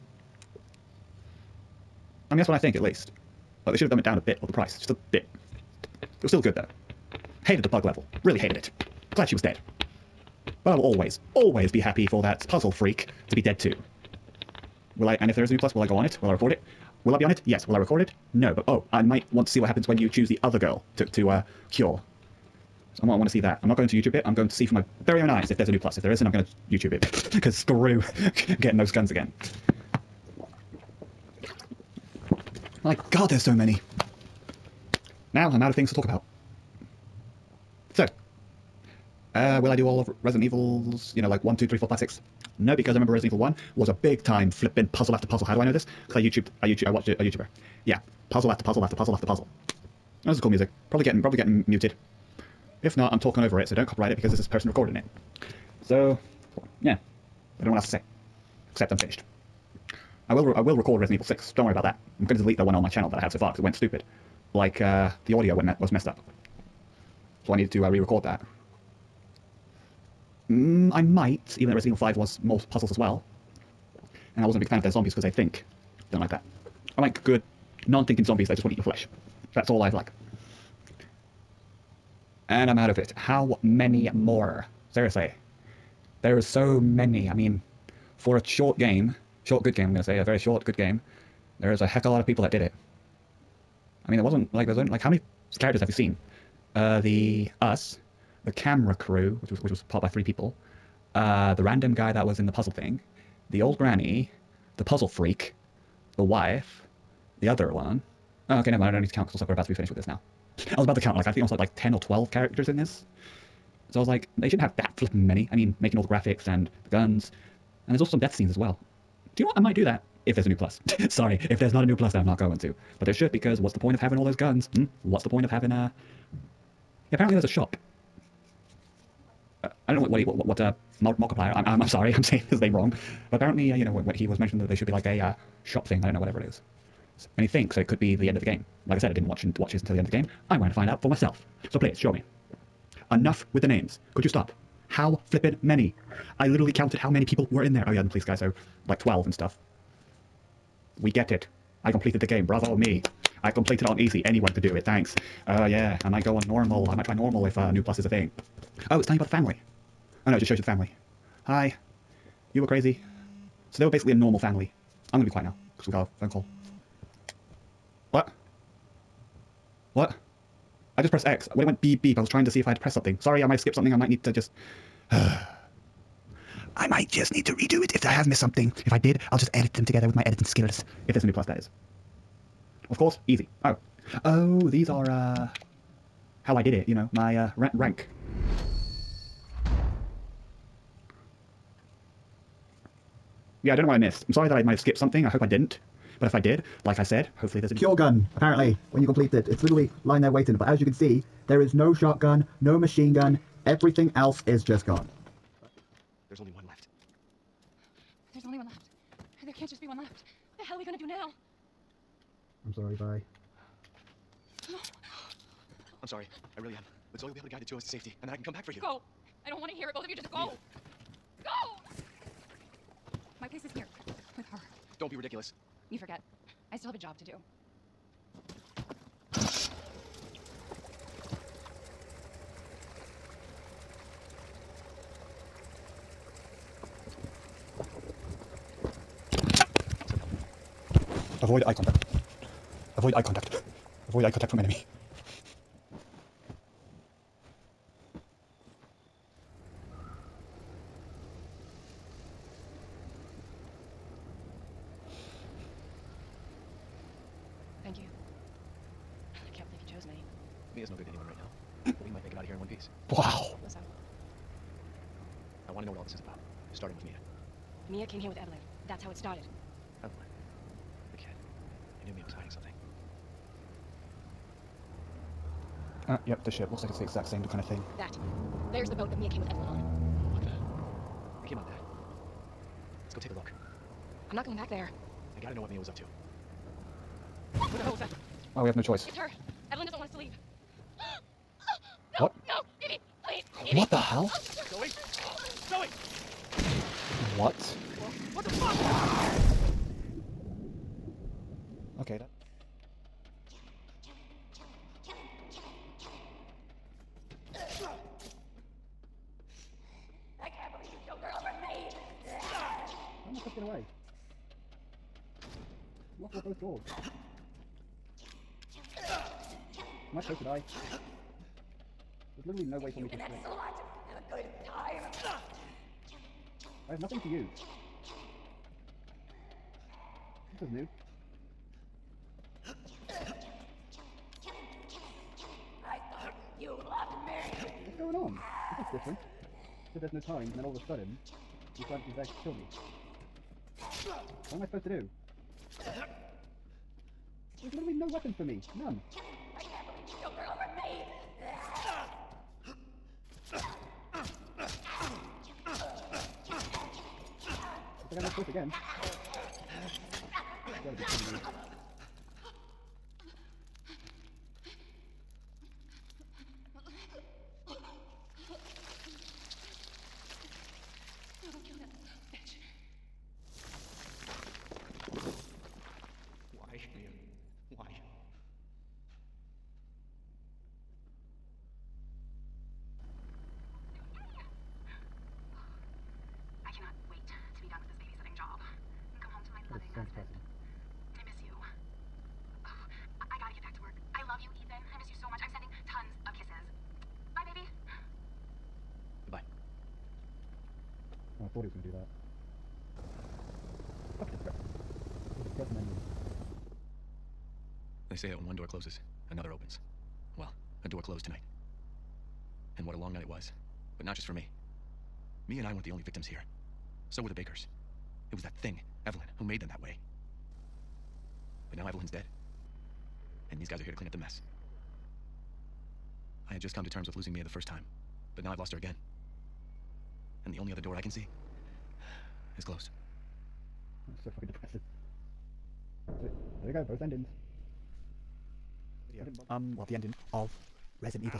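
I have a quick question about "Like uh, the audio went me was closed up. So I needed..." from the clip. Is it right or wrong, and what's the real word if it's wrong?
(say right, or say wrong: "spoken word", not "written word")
wrong: "messed", not "closed".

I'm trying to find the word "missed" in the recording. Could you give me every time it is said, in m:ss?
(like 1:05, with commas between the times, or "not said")
2:58, 3:13.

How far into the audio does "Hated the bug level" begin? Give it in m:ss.
0:07.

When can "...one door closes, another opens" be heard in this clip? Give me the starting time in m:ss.
6:48.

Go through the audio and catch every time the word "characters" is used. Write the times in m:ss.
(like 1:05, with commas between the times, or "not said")
1:35, 1:52.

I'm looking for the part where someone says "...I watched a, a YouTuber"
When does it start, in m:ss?
0:46.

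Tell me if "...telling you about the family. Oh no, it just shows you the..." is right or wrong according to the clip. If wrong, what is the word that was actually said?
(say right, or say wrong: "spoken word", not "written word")
right.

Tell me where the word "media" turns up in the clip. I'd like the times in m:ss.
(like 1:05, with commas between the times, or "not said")
not said.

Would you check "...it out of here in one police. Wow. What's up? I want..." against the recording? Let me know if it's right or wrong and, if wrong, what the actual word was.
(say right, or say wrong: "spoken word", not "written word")
wrong: "piece", not "police".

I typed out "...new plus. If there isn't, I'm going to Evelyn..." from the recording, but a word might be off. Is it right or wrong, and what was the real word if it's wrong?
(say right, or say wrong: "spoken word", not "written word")
wrong: "YouTube", not "Evelyn".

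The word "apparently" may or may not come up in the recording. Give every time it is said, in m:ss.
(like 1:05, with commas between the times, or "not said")
2:07, 2:13, 3:18.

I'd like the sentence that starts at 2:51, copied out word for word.
When it went beep beep, I was trying to see if I had to press something.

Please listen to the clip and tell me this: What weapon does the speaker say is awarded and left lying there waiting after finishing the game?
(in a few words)
Cure gun.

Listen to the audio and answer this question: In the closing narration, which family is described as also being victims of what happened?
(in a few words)
The Bakers.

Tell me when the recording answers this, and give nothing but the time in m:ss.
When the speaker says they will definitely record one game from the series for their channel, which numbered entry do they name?
1:00.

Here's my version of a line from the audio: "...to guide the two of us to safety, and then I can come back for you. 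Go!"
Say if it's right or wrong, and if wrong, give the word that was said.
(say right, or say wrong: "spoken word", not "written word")
right.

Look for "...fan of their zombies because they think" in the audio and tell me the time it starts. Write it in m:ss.
1:14.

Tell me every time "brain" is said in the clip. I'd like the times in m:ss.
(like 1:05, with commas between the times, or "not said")
not said.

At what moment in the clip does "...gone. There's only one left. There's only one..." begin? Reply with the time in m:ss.
3:24.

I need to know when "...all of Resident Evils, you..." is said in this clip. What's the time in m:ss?
0:39.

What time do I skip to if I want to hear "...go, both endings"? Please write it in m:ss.
7:16.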